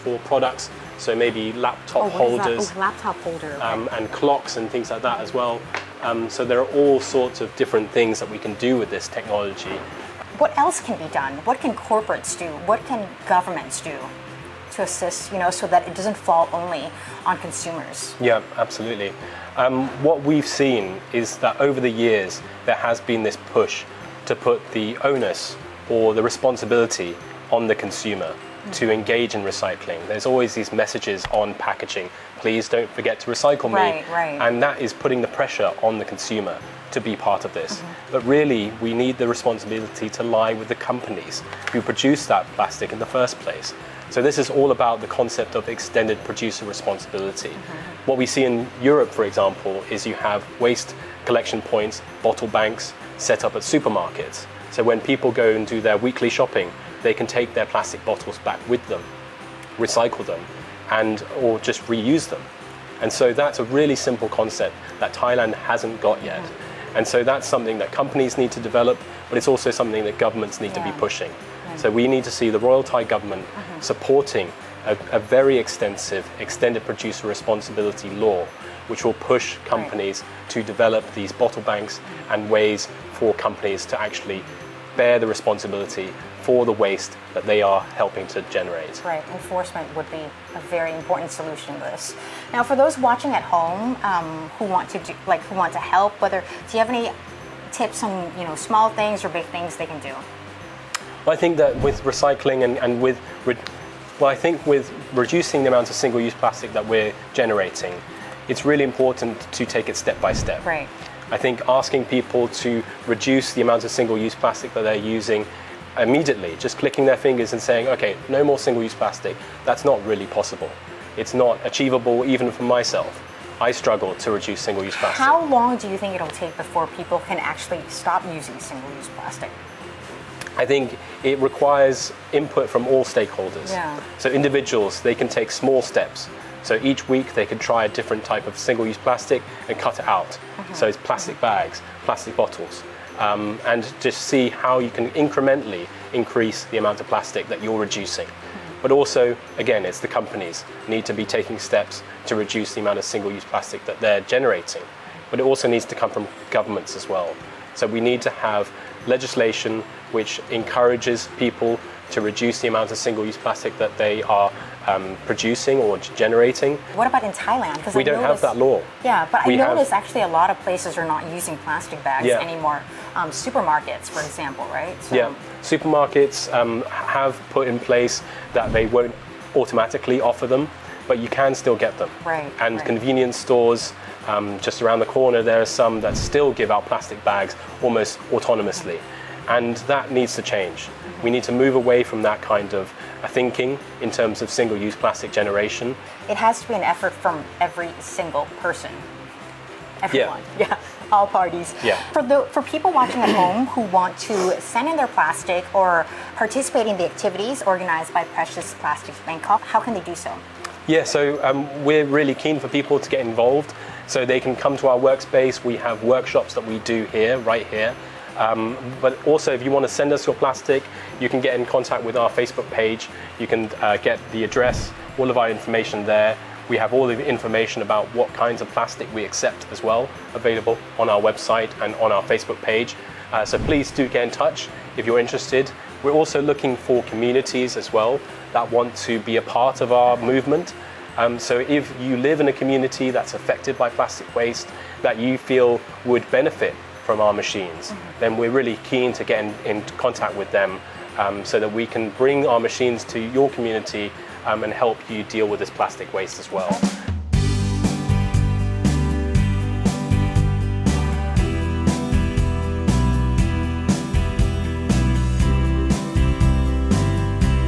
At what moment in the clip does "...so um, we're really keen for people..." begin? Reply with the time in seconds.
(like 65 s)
211 s.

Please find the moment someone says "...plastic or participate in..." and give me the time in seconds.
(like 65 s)
205 s.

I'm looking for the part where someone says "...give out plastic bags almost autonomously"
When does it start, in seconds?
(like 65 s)
186 s.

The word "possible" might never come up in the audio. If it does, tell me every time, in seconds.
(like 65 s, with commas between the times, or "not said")
120 s.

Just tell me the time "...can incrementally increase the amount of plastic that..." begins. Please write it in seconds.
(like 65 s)
144 s.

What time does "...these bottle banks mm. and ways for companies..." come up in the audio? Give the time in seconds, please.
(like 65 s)
81 s.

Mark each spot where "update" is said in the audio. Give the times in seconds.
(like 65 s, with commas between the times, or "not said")
not said.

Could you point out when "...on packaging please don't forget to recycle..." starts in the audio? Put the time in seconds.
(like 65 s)
31 s.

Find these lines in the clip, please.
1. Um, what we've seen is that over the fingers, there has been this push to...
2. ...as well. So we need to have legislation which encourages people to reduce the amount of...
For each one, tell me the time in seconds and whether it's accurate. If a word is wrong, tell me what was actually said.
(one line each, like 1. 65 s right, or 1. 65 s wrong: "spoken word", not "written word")
1. 19 s wrong: "years", not "fingers"
2. 156 s right.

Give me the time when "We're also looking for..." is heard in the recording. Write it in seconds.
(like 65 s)
236 s.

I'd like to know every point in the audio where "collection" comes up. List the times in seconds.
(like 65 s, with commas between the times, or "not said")
51 s.